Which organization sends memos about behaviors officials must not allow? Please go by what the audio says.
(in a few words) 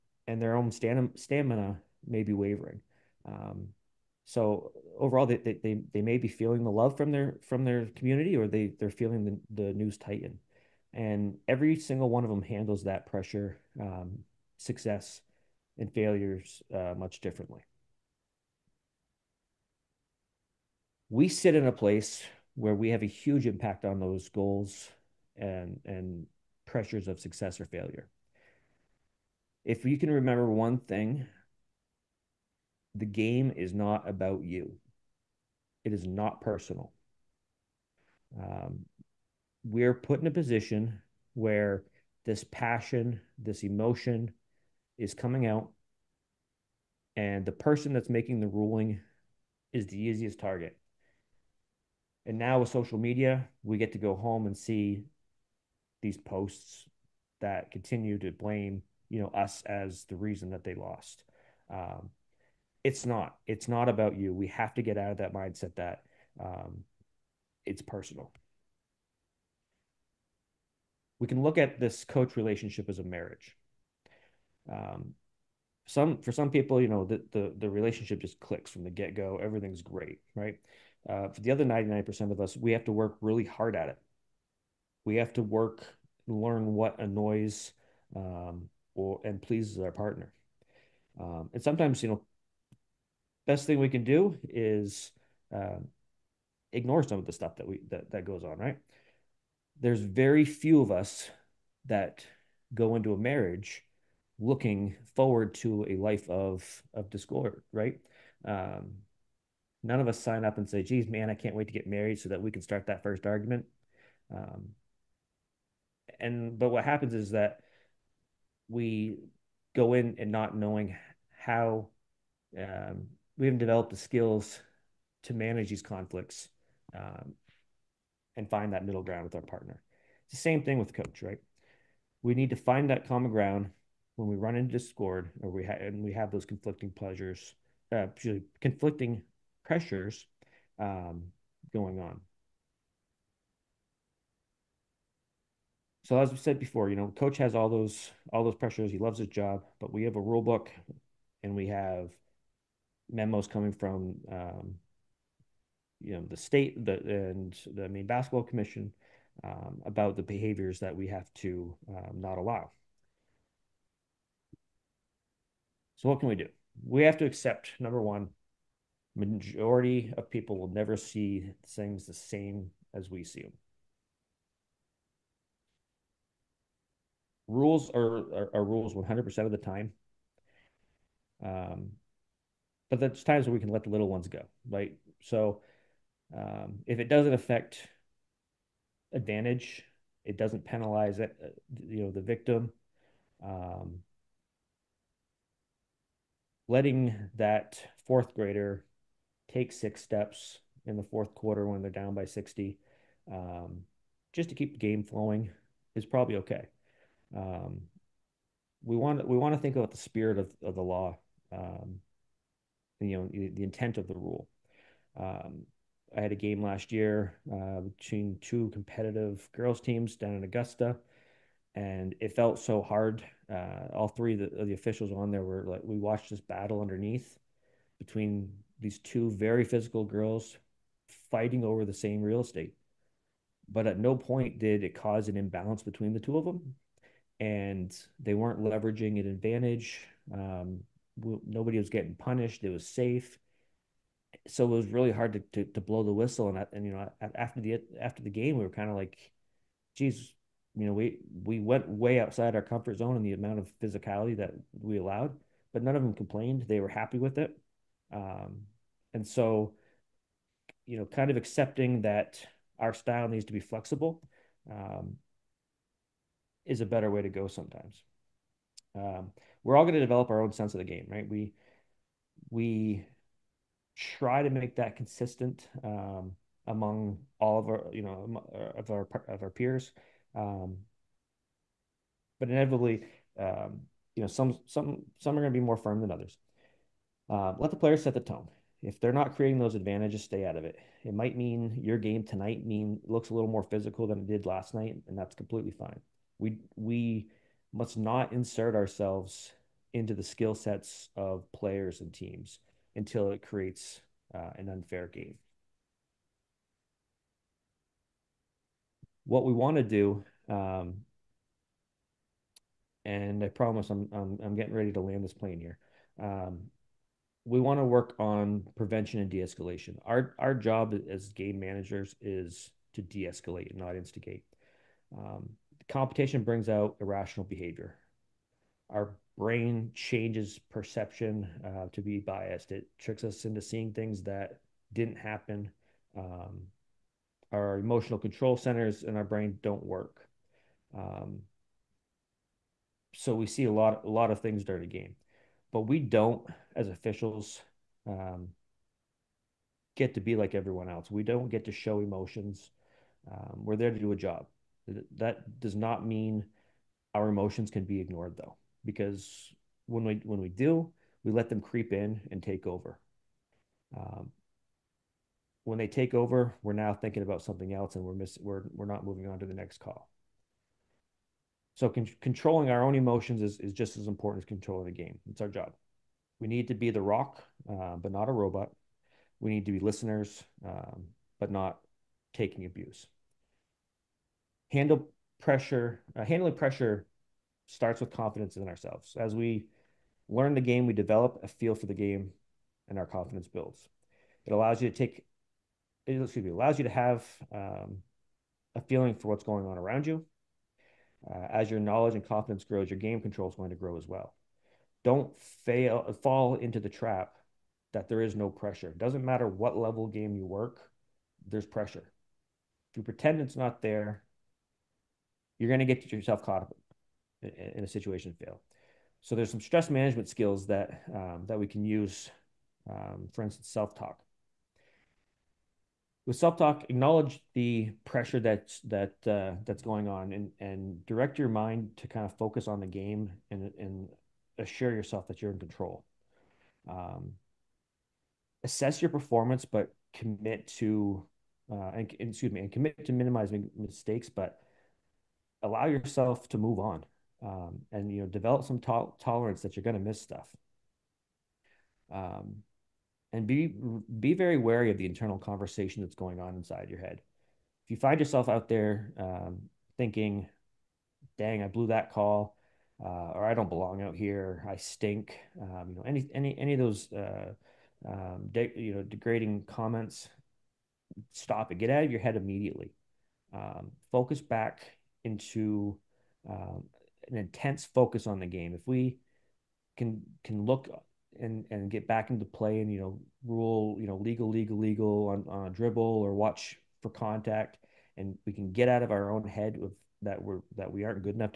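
Maine Basketball Commission.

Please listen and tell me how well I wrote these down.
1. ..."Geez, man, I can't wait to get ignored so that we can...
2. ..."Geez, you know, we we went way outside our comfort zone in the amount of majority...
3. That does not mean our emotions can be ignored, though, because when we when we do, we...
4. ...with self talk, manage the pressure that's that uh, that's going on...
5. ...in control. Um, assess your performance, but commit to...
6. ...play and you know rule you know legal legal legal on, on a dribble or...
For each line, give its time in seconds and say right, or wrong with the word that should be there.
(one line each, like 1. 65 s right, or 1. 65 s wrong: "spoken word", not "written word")
1. 110 s wrong: "married", not "ignored"
2. 249 s wrong: "physicality", not "majority"
3. 355 s right
4. 426 s wrong: "acknowledge", not "manage"
5. 435 s right
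6. 482 s right.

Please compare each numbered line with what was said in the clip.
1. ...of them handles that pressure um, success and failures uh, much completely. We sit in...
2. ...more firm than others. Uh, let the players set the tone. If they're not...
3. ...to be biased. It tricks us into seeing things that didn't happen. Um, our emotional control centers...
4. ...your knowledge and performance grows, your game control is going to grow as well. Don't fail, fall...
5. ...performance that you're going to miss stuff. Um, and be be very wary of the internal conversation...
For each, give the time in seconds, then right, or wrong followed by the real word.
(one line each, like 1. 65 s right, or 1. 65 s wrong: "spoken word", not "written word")
1. 12 s wrong: "differently", not "completely"
2. 285 s right
3. 331 s right
4. 401 s wrong: "confidence", not "performance"
5. 449 s wrong: "tolerance", not "performance".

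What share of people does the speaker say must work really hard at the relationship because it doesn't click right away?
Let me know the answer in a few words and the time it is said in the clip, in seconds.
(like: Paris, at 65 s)
99 percent, at 81 s.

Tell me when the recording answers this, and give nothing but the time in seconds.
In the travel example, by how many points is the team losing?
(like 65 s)
202 s.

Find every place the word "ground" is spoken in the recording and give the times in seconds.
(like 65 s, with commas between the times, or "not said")
129 s, 133 s.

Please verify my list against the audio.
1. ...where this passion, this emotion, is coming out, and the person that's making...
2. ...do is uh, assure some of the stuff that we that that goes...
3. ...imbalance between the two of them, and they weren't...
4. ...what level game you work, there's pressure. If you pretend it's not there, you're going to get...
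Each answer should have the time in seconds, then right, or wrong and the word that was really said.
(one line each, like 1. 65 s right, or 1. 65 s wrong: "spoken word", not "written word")
1. 41 s right
2. 94 s wrong: "ignore", not "assure"
3. 235 s right
4. 409 s right.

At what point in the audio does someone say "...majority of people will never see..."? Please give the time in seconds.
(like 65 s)
169 s.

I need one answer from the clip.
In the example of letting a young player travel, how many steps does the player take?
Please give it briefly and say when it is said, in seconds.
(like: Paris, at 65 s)
6, at 199 s.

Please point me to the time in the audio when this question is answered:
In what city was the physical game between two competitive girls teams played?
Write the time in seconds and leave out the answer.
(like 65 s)
220 s.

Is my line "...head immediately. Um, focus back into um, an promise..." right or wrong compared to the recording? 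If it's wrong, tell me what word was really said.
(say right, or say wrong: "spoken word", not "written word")
wrong: "intense", not "promise".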